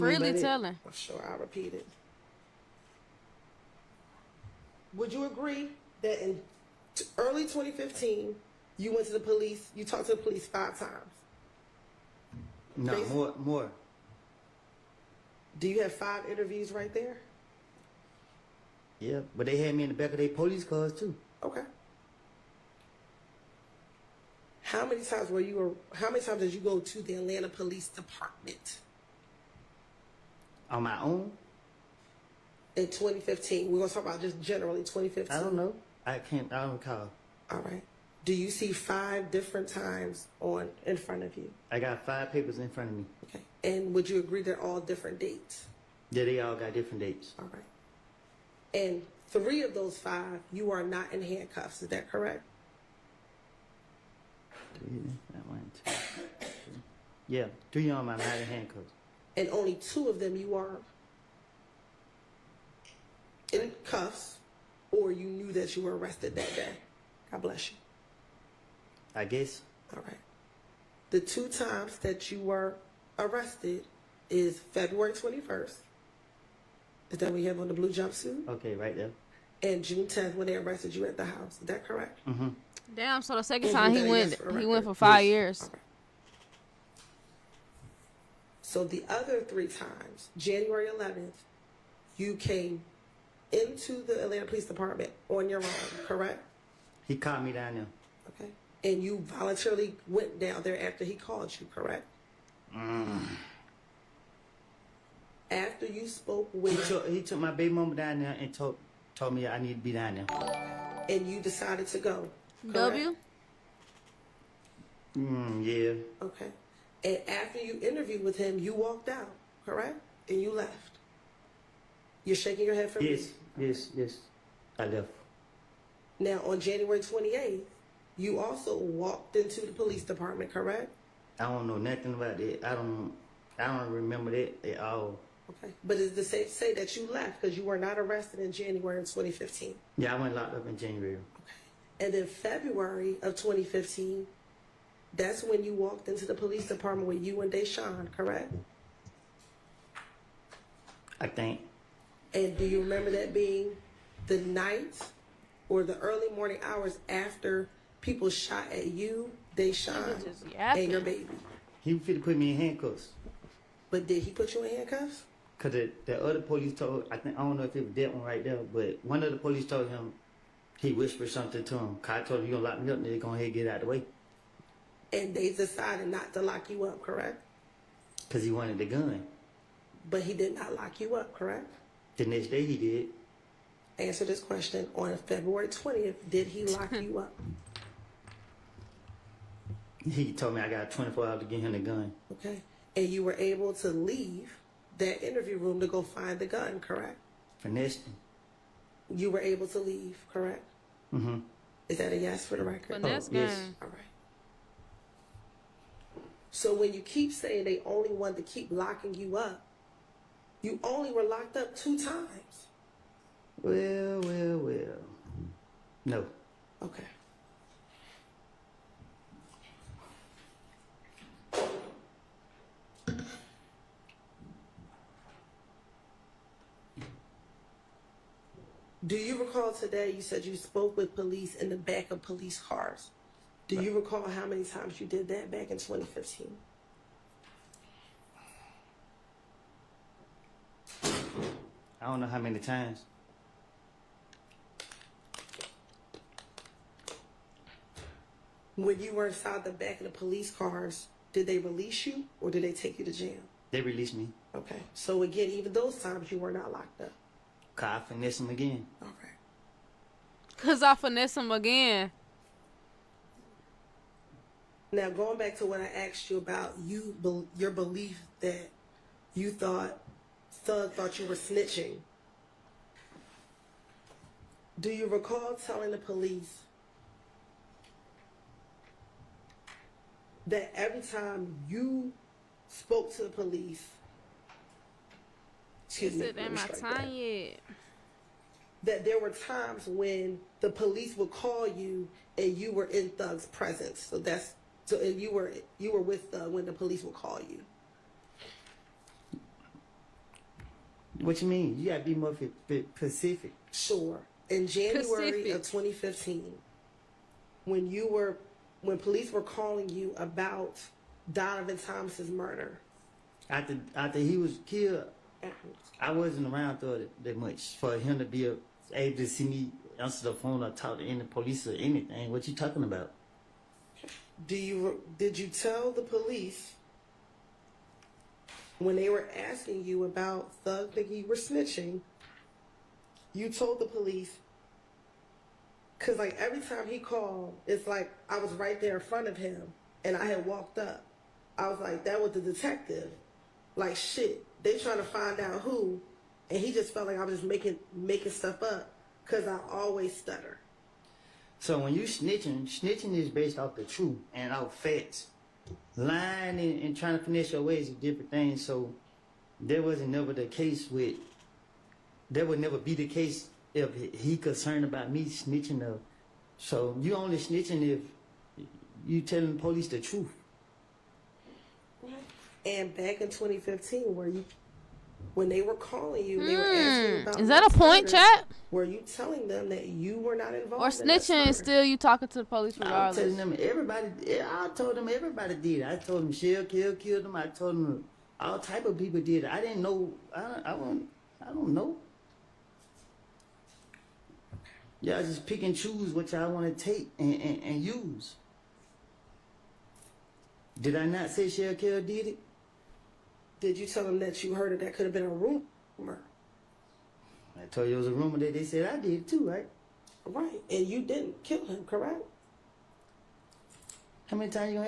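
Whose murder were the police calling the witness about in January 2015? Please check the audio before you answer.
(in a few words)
Donovan Thomas.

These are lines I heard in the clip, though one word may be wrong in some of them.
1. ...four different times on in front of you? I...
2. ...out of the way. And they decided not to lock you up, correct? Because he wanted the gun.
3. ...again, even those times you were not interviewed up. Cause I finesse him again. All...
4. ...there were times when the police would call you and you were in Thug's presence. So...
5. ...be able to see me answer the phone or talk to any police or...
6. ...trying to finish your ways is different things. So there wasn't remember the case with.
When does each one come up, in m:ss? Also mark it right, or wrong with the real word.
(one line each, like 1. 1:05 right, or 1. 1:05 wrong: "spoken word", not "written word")
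1. 0:38 wrong: "five", not "four"
2. 2:53 right
3. 4:15 wrong: "locked", not "interviewed"
4. 4:49 right
5. 5:18 right
6. 5:56 wrong: "never", not "remember".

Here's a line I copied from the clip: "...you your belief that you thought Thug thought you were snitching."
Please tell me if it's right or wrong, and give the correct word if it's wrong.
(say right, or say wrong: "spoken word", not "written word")
right.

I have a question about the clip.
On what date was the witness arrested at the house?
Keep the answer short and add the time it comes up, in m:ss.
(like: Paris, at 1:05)
June 10th, at 1:19.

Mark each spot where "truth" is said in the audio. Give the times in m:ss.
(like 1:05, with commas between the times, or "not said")
5:53, 6:09.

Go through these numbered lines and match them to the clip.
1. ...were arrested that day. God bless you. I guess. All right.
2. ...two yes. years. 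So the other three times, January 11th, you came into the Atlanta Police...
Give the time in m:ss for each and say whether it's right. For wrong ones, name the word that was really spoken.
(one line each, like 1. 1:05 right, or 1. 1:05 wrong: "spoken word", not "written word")
1. 1:05 right
2. 1:24 wrong: "five", not "two".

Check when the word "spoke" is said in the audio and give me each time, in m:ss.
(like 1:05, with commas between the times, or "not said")
1:46, 3:50, 4:42.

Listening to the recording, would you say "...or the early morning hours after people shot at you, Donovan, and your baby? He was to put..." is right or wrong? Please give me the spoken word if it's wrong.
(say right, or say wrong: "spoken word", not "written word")
wrong: "Deshawn", not "Donovan".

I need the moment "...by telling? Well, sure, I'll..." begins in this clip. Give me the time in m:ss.
0:00.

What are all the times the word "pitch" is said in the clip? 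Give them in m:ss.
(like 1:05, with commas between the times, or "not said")
not said.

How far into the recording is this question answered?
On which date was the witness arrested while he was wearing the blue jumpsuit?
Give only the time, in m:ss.
1:14.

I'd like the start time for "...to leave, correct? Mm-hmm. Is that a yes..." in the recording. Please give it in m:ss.
3:19.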